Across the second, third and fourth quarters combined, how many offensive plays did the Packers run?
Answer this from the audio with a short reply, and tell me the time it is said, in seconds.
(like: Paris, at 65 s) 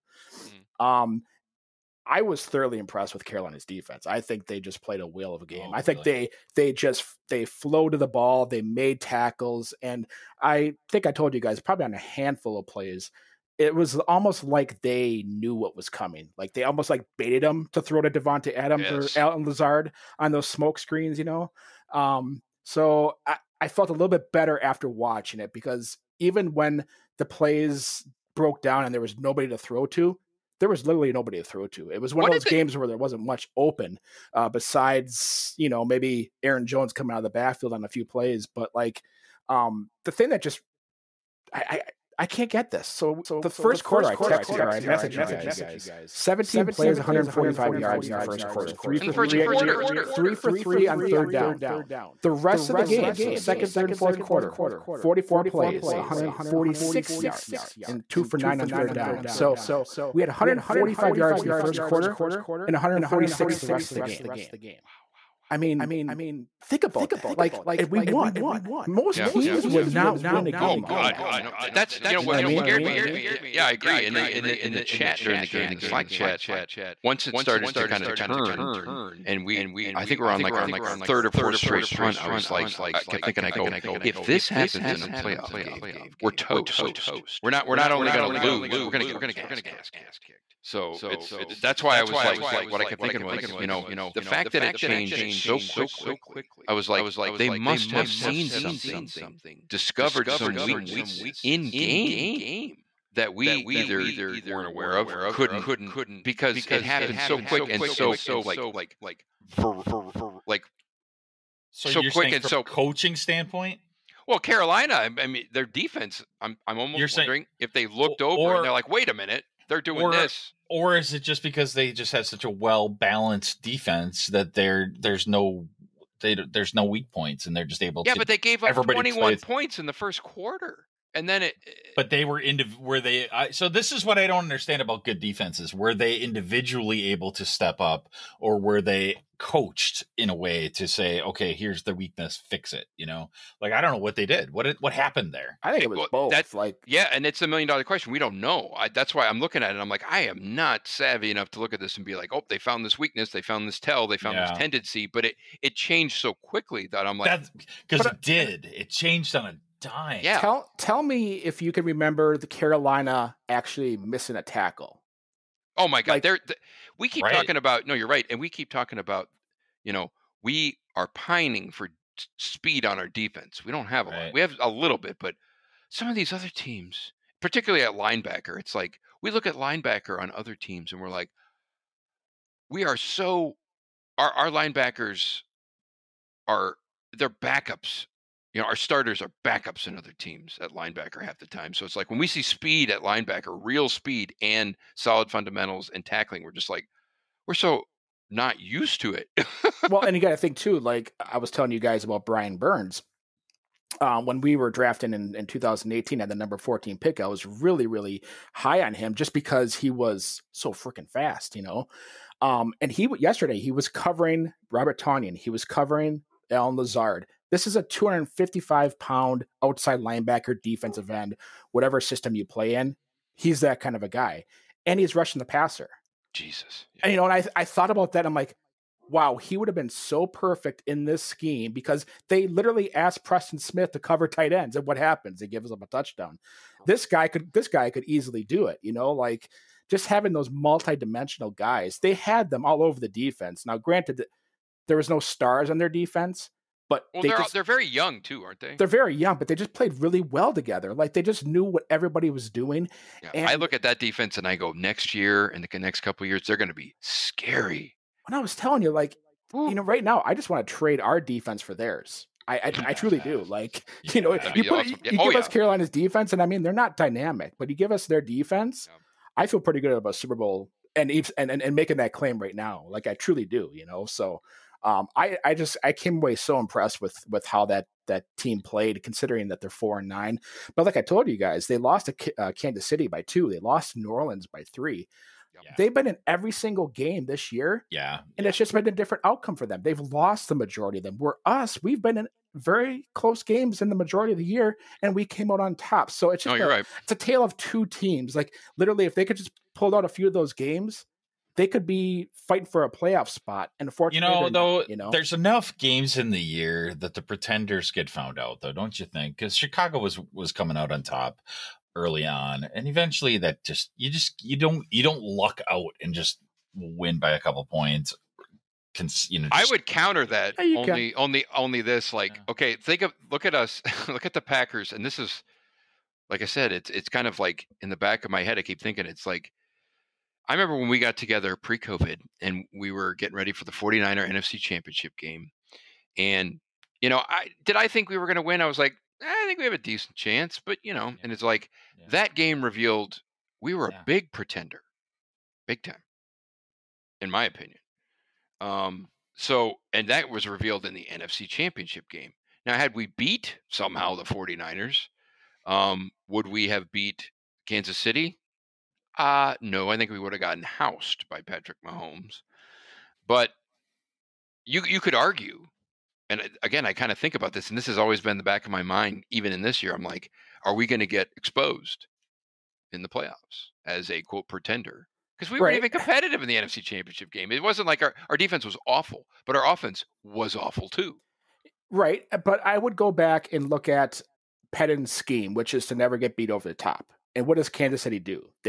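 44, at 54 s.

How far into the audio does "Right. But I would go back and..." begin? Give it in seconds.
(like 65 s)
381 s.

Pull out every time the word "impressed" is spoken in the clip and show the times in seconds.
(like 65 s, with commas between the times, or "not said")
2 s, 276 s.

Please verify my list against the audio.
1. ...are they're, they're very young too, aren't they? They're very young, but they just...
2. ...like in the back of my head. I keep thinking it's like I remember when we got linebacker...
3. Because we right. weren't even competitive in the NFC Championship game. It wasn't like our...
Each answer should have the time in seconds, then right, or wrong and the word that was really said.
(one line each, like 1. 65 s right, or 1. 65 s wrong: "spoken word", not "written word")
1. 247 s right
2. 327 s wrong: "together", not "linebacker"
3. 375 s right.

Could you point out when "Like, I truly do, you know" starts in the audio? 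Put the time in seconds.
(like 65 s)
272 s.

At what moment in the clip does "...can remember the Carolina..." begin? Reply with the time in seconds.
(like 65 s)
161 s.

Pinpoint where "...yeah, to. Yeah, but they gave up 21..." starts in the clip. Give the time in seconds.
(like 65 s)
128 s.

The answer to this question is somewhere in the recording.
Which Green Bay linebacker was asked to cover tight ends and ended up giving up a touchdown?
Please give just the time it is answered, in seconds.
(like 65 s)
233 s.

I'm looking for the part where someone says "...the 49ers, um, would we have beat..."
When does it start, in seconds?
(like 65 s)
354 s.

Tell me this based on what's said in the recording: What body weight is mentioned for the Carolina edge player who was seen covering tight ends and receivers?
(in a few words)
255 pounds.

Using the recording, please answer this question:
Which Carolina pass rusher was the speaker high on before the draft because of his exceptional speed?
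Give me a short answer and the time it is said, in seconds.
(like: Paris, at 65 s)
Brian Burns, at 202 s.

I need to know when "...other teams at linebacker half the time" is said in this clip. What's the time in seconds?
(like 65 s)
189 s.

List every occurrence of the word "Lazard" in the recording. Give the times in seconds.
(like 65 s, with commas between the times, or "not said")
19 s, 216 s.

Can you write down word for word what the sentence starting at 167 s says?
No, you're right, and we keep talking about.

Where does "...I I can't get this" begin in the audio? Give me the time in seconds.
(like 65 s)
41 s.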